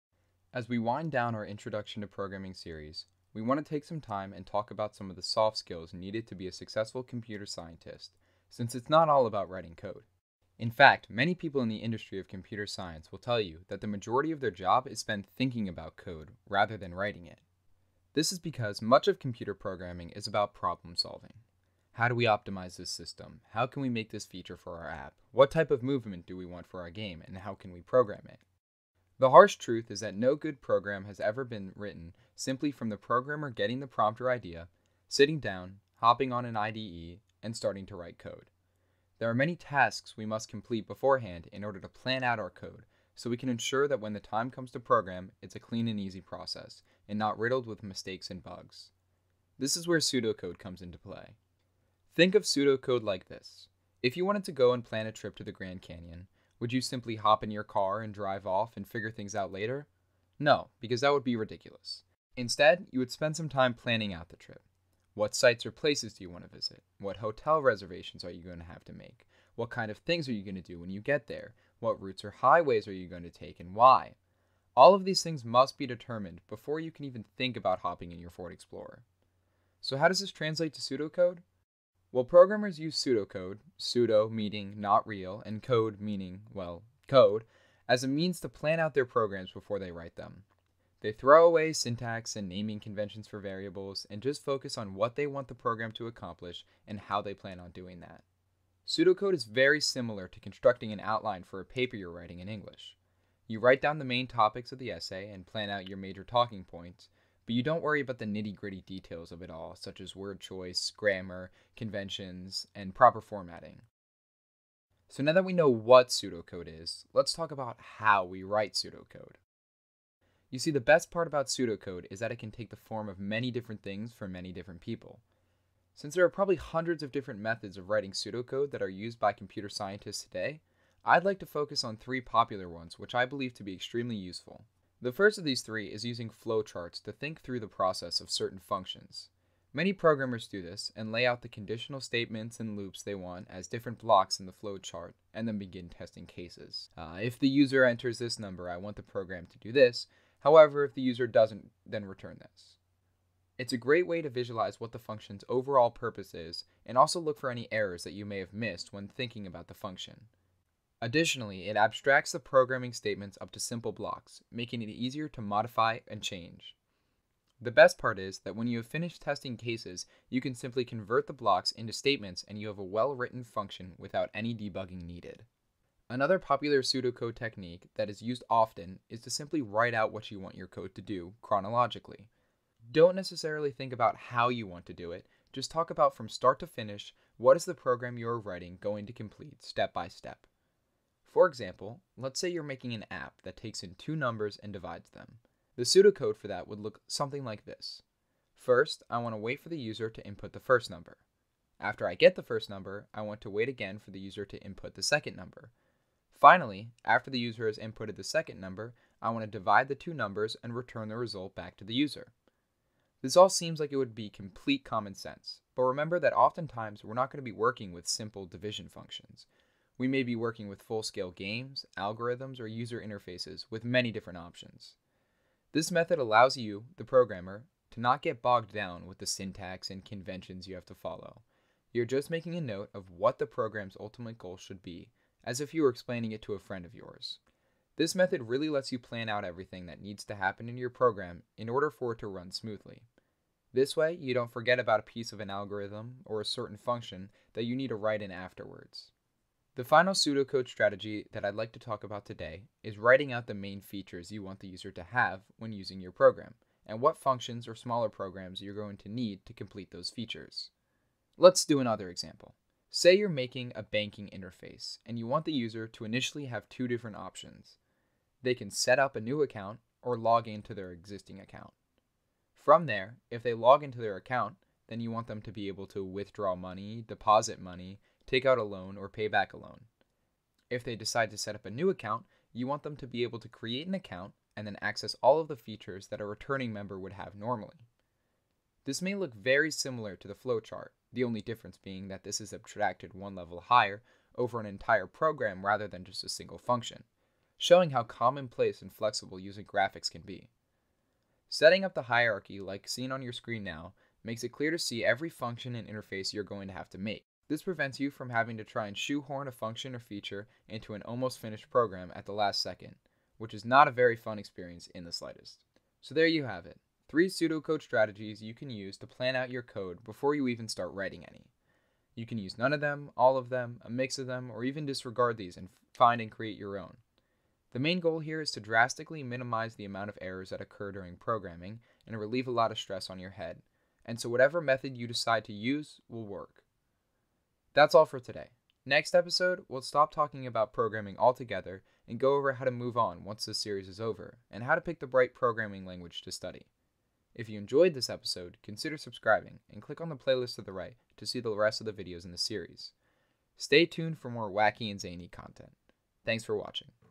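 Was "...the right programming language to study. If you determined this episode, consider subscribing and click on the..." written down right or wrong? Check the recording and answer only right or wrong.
wrong.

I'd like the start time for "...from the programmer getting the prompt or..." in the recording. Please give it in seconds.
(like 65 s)
32 s.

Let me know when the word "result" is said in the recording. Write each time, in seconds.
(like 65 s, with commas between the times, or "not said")
211 s.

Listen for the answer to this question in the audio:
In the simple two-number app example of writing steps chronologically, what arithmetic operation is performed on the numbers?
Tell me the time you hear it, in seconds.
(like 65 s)
194 s.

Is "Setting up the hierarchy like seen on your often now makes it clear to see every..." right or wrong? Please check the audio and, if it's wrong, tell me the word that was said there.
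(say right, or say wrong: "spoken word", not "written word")
wrong: "screen", not "often".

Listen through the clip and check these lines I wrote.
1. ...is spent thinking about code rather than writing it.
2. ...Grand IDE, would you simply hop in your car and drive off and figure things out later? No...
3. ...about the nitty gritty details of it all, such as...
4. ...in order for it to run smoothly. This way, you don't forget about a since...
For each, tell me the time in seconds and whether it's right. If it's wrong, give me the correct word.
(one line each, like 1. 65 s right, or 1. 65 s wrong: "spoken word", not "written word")
1. 14 s right
2. 55 s wrong: "Canyon", not "IDE"
3. 107 s right
4. 241 s wrong: "piece", not "since".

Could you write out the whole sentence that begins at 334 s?
And so, whatever method you decide to use will work.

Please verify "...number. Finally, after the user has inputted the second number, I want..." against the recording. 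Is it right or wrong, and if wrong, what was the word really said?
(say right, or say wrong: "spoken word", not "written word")
right.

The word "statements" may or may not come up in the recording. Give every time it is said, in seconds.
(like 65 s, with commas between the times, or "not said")
142 s, 162 s, 171 s.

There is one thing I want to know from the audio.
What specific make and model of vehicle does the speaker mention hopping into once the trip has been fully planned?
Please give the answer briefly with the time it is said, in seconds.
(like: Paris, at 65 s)
Ford Explorer, at 78 s.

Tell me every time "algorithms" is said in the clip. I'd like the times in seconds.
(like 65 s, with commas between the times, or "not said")
221 s, 245 s.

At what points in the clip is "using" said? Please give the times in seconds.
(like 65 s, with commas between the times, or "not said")
136 s, 255 s, 299 s.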